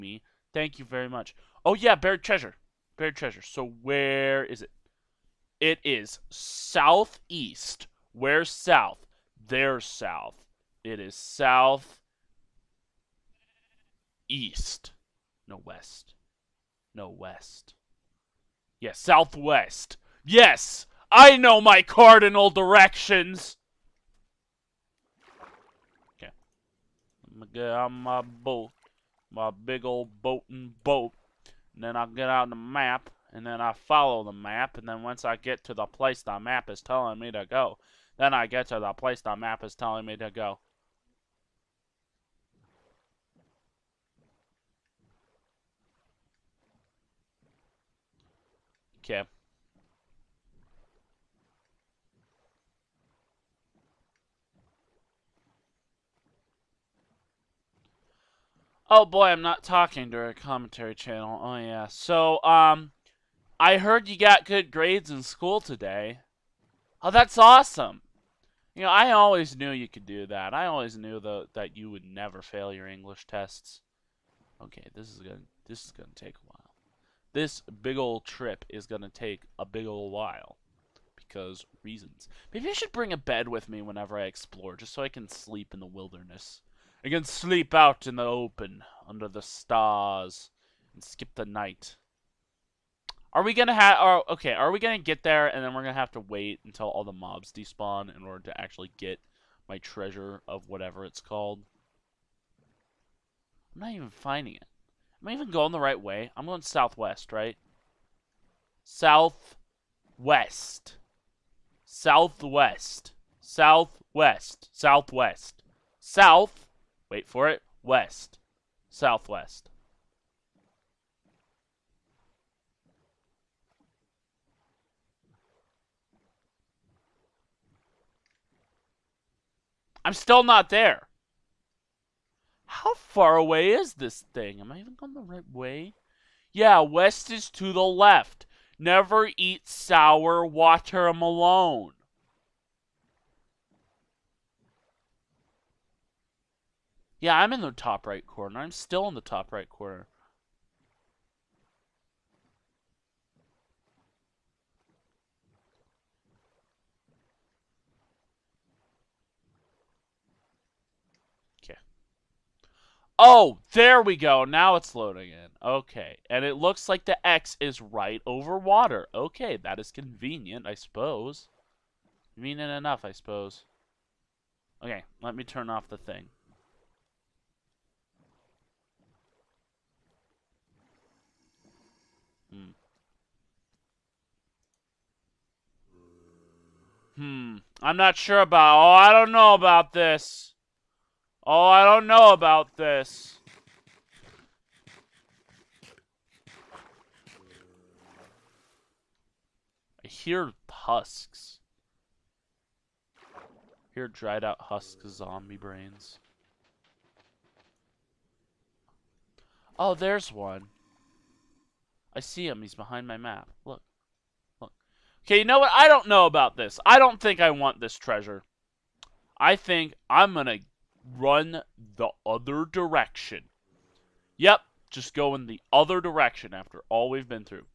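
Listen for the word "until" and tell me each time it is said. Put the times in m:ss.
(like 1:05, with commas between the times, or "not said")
1:36.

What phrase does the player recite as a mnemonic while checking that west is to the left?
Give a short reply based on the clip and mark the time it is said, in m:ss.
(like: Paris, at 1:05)
Never eat sour water alone, at 2:18.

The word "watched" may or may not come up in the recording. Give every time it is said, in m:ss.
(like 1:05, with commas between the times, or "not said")
not said.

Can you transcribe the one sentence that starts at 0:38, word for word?
Then I get to the place the map is telling me to go.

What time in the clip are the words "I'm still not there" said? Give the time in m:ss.
2:10.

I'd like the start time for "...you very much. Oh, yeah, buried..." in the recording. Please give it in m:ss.
0:00.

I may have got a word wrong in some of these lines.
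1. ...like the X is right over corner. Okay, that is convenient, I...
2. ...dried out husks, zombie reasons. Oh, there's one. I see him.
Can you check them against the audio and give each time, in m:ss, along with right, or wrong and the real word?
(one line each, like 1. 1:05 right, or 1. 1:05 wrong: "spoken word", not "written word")
1. 2:46 wrong: "water", not "corner"
2. 3:24 wrong: "brains", not "reasons".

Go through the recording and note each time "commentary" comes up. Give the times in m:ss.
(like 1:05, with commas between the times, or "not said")
1:00.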